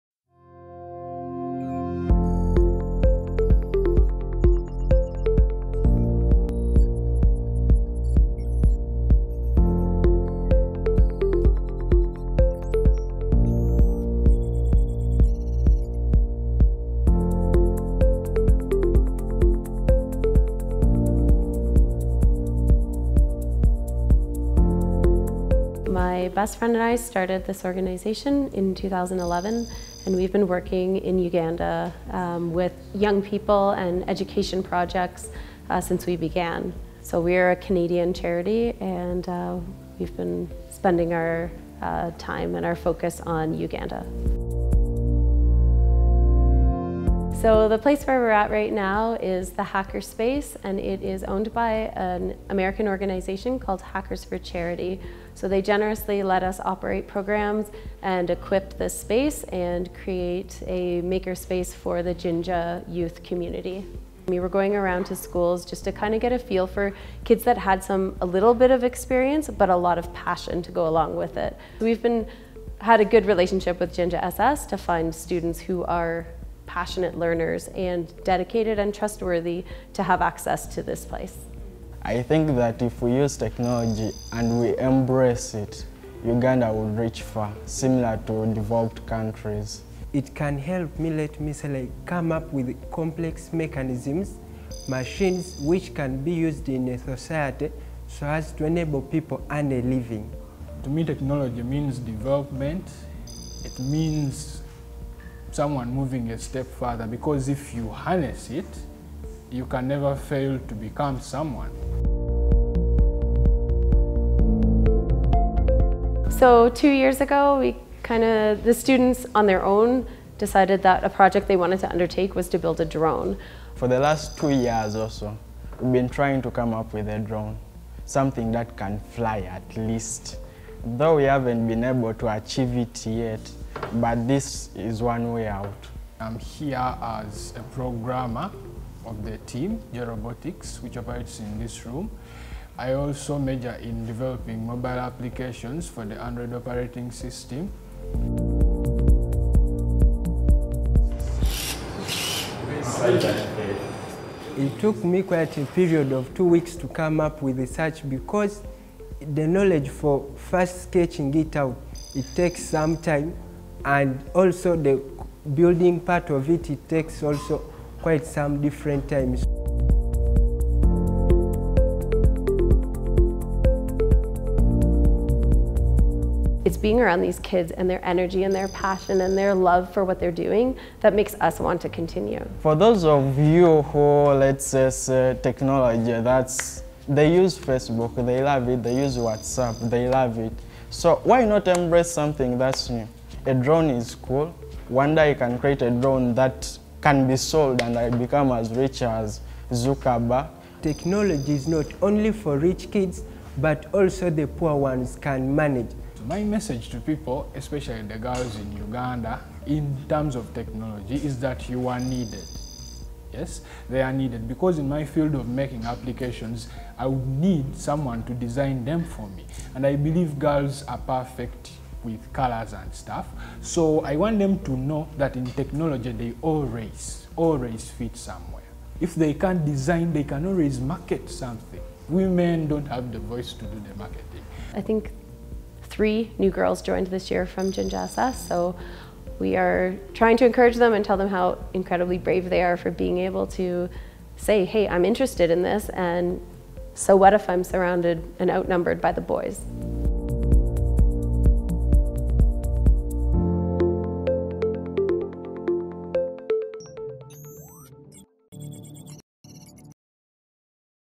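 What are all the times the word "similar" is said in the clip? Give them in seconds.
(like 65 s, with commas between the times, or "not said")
87 s.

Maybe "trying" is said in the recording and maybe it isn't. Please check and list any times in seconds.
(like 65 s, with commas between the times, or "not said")
126 s, 240 s.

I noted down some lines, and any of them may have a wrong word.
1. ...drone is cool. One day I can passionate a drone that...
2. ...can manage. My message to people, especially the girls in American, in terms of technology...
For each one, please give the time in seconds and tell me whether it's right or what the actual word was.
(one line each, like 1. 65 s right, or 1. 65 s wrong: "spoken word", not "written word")
1. 193 s wrong: "create", not "passionate"
2. 205 s wrong: "Uganda", not "American".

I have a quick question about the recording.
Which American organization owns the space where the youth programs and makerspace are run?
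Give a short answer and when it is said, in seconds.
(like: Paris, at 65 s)
Hackers for Charity, at 53 s.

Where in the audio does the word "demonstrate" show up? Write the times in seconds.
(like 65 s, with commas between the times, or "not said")
not said.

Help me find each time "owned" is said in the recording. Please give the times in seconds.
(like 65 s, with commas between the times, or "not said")
51 s.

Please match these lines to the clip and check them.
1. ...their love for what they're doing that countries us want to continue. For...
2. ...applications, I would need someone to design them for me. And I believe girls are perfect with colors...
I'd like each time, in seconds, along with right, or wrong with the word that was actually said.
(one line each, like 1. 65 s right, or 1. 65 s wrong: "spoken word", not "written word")
1. 179 s wrong: "makes", not "countries"
2. 215 s right.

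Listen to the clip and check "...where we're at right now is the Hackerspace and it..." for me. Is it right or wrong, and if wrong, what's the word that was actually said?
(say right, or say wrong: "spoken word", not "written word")
right.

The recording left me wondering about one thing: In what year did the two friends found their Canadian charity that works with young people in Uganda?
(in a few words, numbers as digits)
2011.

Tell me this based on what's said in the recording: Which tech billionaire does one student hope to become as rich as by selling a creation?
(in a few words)
Zuckerberg.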